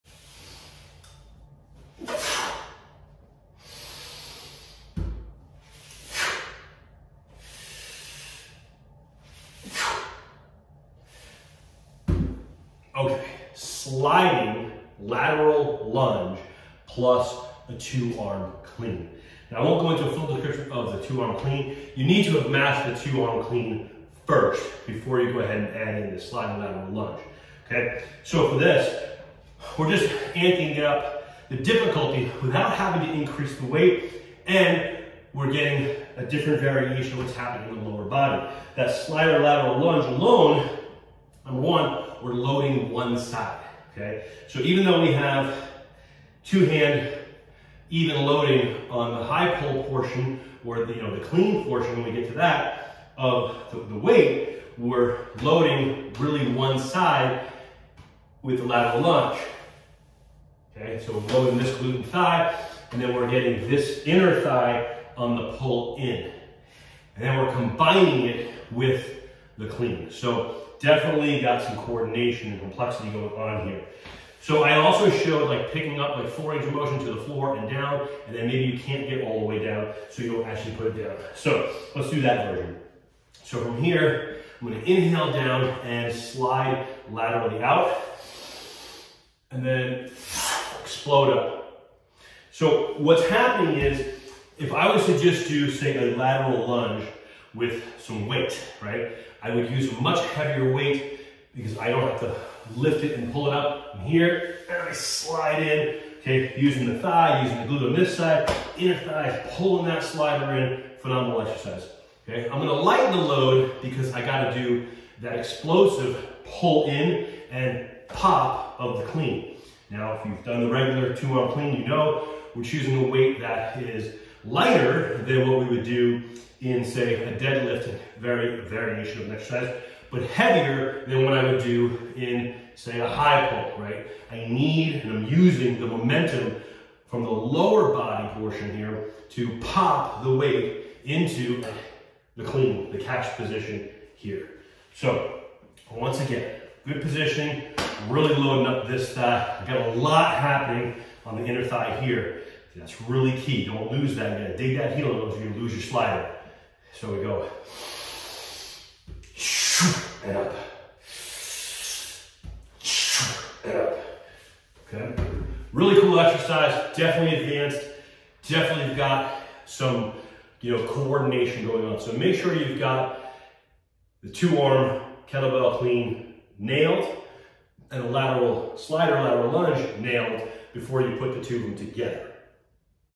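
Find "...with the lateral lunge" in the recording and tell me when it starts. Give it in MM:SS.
00:58.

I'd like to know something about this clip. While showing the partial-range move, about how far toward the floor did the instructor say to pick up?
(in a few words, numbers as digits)
4 inches.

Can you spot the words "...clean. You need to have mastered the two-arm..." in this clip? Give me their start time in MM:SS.
00:21.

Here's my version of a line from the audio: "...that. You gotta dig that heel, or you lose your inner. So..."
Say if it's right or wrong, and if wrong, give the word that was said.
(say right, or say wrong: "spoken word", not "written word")
wrong: "slider", not "inner".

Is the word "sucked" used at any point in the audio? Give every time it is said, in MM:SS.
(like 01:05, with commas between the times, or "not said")
not said.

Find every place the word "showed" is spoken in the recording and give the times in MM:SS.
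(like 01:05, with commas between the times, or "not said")
01:15.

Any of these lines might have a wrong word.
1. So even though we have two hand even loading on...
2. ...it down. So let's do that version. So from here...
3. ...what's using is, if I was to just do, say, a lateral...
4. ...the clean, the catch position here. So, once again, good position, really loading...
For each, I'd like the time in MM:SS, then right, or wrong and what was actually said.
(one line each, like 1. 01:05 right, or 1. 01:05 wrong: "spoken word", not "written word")
1. 00:44 right
2. 01:20 right
3. 01:32 wrong: "happening", not "using"
4. 02:22 right.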